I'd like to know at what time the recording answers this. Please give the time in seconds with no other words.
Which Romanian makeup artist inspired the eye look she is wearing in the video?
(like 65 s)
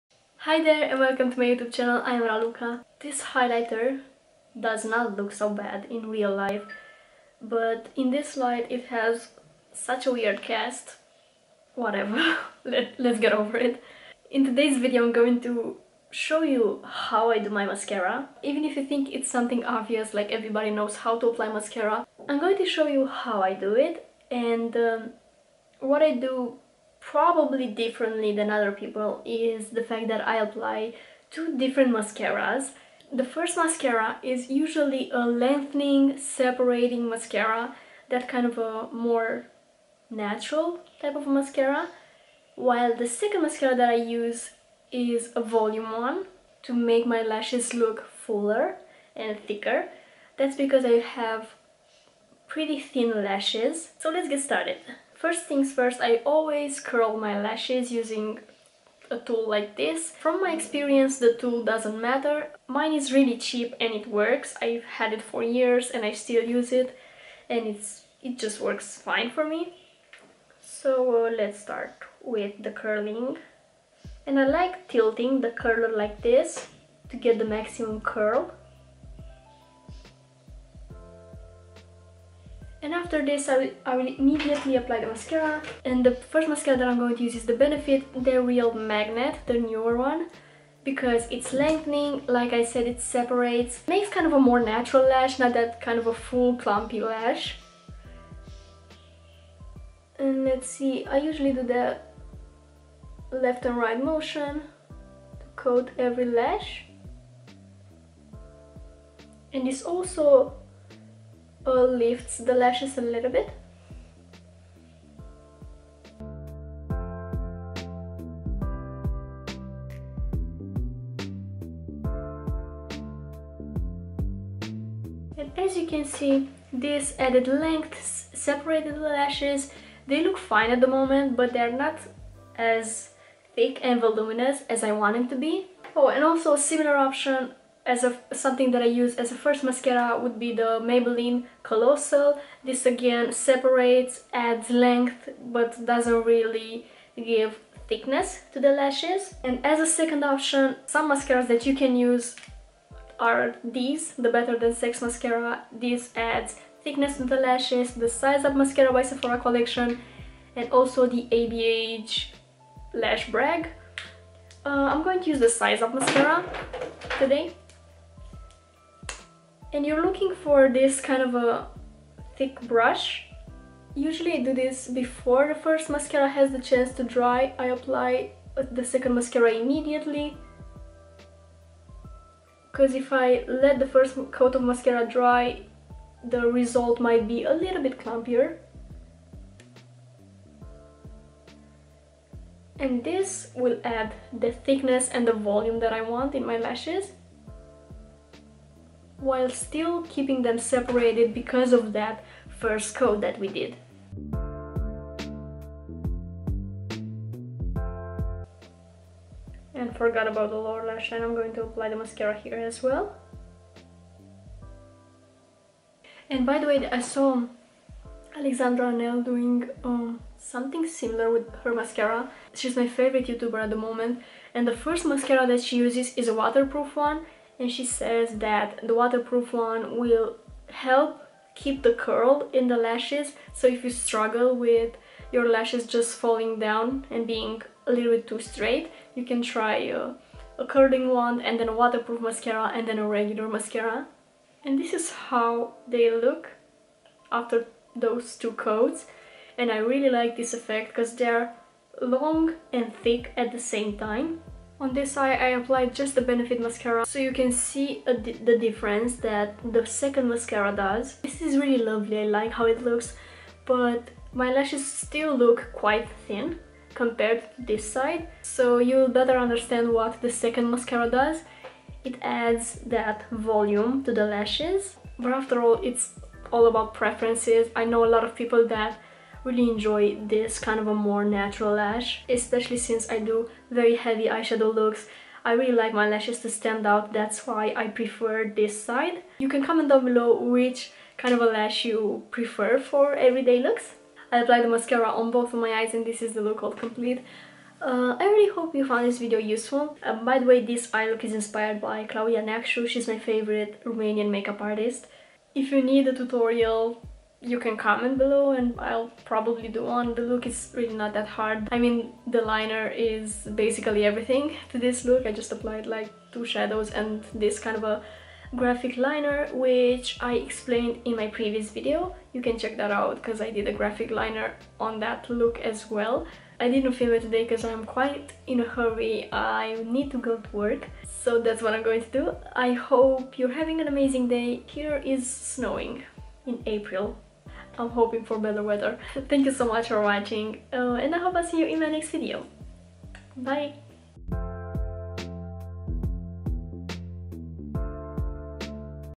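302 s.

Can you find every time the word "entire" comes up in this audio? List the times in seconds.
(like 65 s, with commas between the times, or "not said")
not said.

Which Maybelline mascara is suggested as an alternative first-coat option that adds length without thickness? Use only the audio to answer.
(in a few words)
Maybelline Colossal.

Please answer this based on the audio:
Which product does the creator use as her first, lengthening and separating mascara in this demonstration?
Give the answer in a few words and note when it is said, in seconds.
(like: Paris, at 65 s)
Benefit They're Real Magnet, at 87 s.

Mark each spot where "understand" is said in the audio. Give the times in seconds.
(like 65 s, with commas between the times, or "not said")
269 s.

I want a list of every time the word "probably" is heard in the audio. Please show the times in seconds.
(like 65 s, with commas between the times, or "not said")
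27 s, 309 s.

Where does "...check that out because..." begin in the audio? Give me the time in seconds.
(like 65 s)
322 s.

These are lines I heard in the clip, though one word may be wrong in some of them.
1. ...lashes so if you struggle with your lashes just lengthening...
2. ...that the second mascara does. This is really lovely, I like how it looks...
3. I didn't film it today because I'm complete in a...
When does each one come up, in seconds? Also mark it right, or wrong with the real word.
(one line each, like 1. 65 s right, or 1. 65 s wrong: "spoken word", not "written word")
1. 232 s wrong: "falling", not "lengthening"
2. 259 s right
3. 326 s wrong: "quite", not "complete".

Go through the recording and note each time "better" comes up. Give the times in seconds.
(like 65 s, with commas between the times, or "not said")
154 s, 269 s, 338 s.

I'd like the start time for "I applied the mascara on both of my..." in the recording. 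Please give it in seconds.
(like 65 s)
294 s.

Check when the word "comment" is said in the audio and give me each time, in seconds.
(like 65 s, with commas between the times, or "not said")
289 s, 307 s.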